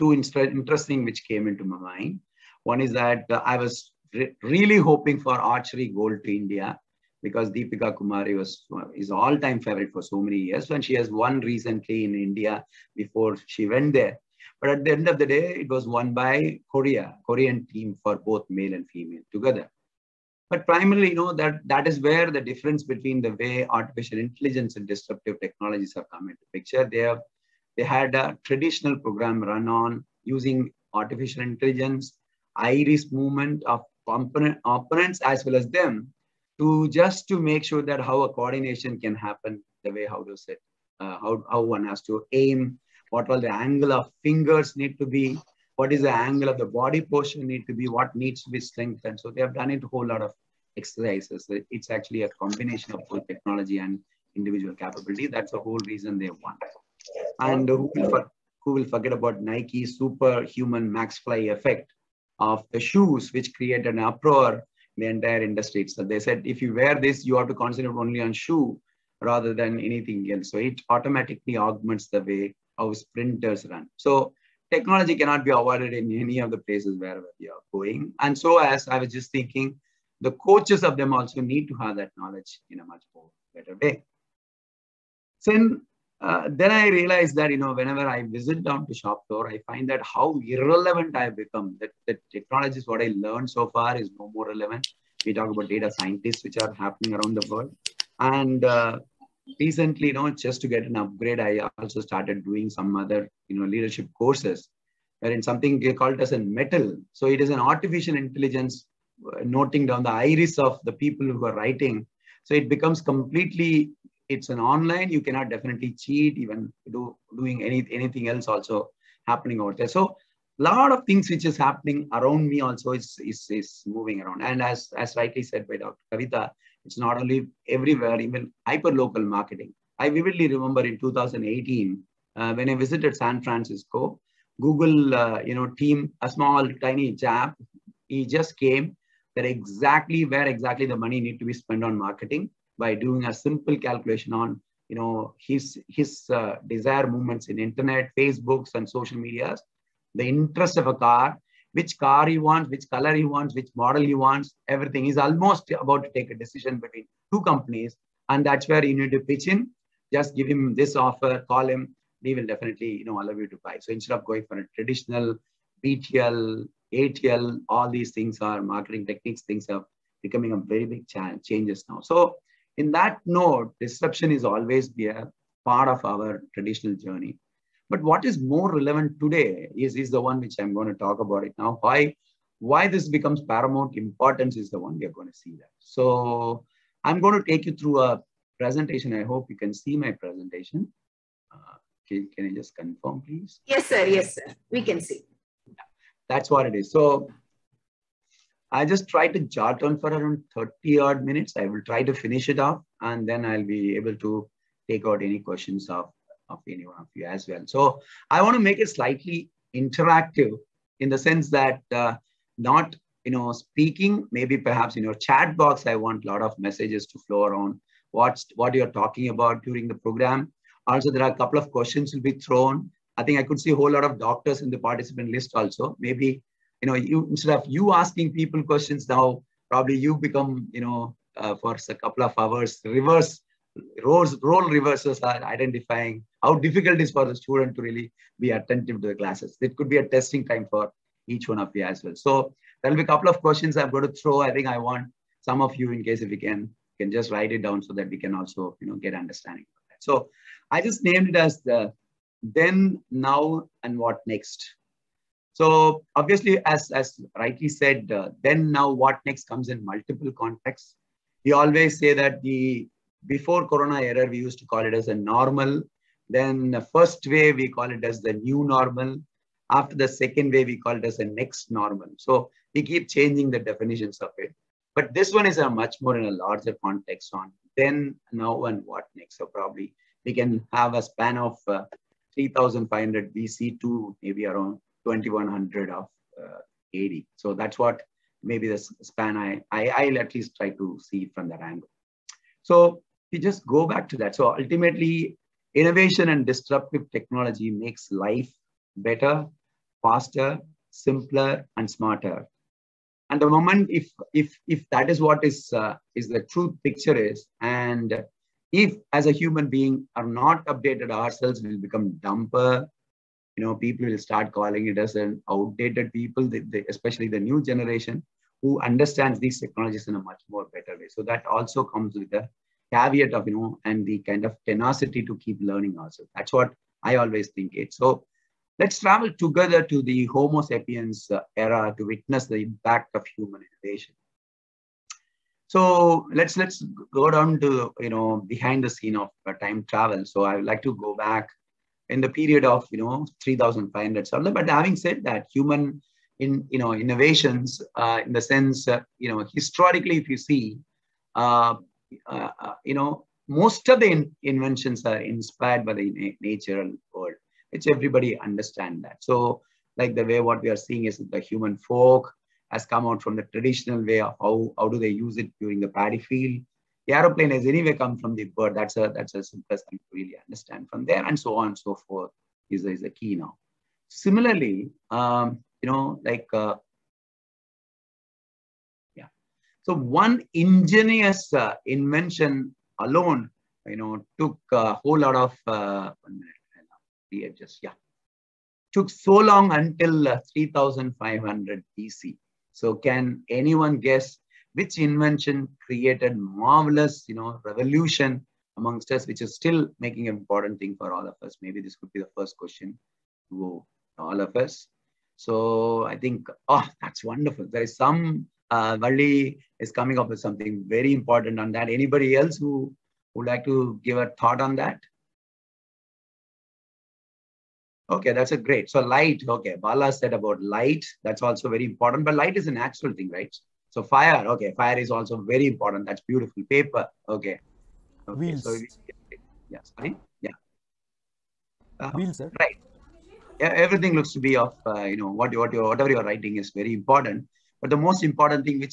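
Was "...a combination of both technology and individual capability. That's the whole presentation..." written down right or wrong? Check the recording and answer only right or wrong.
wrong.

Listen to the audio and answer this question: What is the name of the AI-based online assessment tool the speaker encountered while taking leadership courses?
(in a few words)
Mettl.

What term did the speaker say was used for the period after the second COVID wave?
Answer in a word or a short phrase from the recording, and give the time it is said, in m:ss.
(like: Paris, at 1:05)
next normal, at 4:31.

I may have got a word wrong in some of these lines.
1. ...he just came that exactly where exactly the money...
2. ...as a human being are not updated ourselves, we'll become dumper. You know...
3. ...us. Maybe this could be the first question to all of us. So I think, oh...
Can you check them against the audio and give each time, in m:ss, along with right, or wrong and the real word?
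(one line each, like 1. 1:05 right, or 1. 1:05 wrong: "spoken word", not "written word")
1. 2:18 right
2. 5:09 right
3. 6:41 right.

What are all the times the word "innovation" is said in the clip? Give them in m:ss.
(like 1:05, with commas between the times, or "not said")
4:55, 5:33, 5:46.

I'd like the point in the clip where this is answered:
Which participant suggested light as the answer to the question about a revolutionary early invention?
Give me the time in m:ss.
6:59.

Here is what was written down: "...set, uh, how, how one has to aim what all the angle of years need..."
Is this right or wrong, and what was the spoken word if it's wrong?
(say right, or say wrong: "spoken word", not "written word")
wrong: "fingers", not "years".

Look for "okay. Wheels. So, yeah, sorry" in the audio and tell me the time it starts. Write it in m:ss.
7:08.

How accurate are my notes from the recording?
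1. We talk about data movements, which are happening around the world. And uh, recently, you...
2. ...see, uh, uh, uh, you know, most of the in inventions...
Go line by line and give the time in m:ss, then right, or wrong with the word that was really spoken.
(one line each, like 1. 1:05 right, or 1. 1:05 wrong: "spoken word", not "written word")
1. 1:35 wrong: "scientists", not "movements"
2. 5:50 right.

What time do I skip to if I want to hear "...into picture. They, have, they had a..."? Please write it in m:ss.
0:26.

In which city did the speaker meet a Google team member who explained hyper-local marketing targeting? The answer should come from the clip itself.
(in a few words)
San Francisco.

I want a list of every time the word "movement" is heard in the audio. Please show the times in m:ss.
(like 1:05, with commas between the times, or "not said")
0:33, 2:27.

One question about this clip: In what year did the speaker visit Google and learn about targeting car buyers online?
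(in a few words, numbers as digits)
2018.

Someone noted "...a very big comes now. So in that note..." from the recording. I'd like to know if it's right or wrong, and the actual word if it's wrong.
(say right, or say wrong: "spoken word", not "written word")
wrong: "changes", not "comes".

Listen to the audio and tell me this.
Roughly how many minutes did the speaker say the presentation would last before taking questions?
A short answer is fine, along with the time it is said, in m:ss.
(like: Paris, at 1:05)
30, at 3:20.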